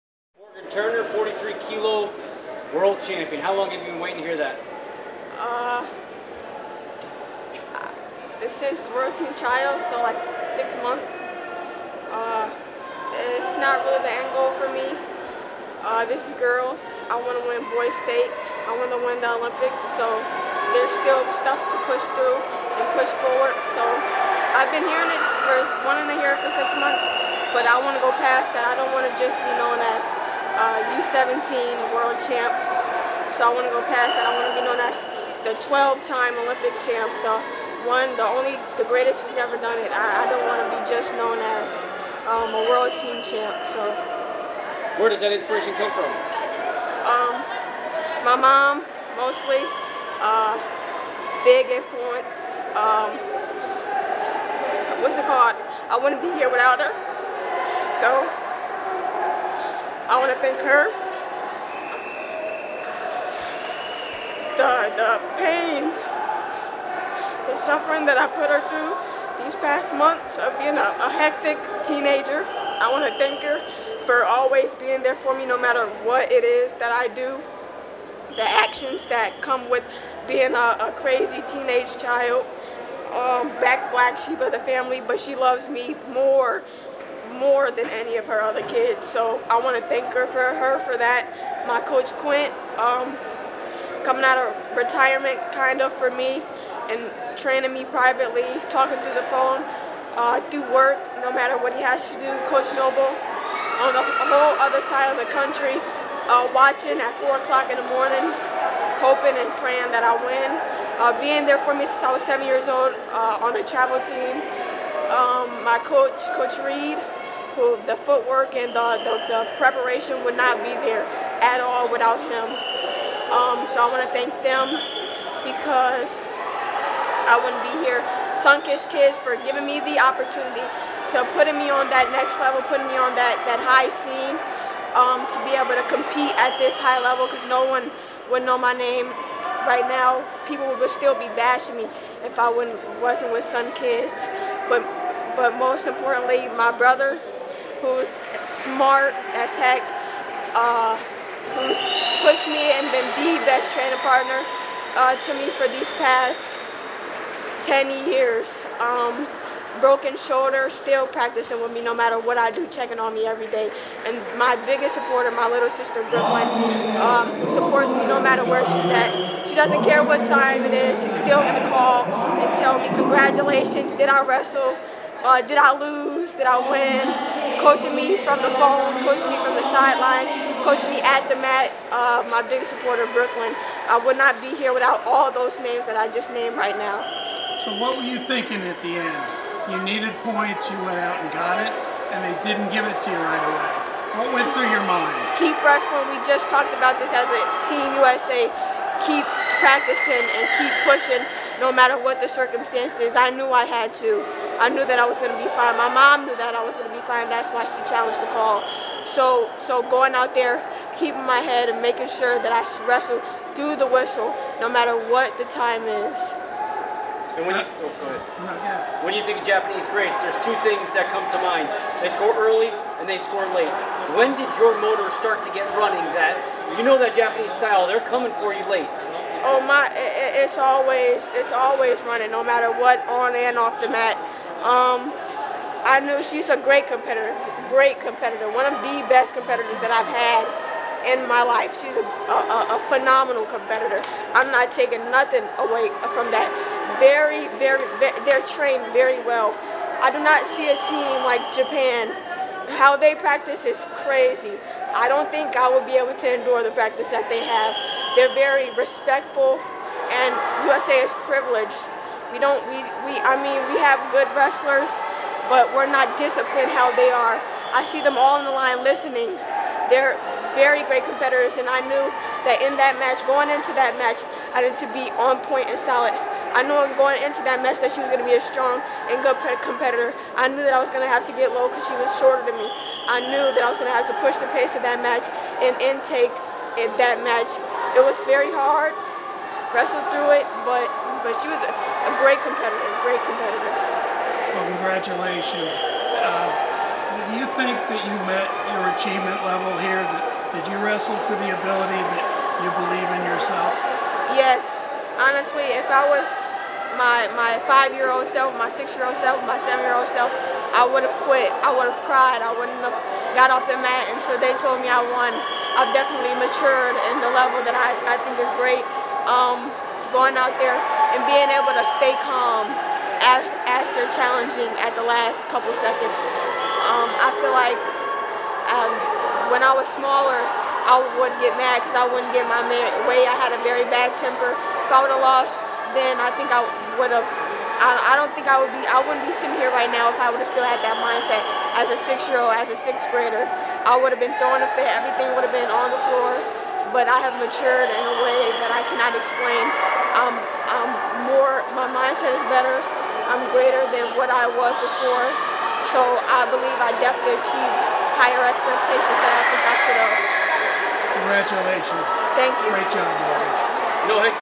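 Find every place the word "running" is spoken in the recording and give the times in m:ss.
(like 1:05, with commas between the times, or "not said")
3:45, 3:52.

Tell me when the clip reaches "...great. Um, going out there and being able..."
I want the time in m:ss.
5:18.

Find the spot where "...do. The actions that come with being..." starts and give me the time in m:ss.
1:17.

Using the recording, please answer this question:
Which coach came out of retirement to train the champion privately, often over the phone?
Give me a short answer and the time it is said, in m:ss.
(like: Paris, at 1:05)
Quint, at 1:32.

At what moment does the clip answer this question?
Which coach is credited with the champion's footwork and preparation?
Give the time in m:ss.
1:56.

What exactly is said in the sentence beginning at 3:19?
Keep practicing and keep pushing no matter what the circumstances, I knew I had to.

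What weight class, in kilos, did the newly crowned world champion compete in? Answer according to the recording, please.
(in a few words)
43 kilo.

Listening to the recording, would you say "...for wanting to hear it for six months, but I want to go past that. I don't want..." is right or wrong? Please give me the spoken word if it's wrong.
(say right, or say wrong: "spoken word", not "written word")
right.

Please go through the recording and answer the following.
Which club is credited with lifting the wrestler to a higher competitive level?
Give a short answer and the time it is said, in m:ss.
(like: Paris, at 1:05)
Sunkist Kids, at 2:08.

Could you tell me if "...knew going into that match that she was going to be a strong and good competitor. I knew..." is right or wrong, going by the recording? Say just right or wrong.
right.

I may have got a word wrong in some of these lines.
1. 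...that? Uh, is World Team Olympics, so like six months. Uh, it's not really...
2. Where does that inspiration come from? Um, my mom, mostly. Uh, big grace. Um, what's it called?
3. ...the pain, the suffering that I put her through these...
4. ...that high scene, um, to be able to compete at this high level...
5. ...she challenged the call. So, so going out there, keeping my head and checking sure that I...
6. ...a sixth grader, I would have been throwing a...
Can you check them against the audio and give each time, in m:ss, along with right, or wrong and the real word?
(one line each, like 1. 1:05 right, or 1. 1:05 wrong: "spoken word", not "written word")
1. 0:04 wrong: "Trials", not "Olympics"
2. 0:45 wrong: "influence", not "grace"
3. 1:04 right
4. 2:13 right
5. 3:27 wrong: "making", not "checking"
6. 5:42 right.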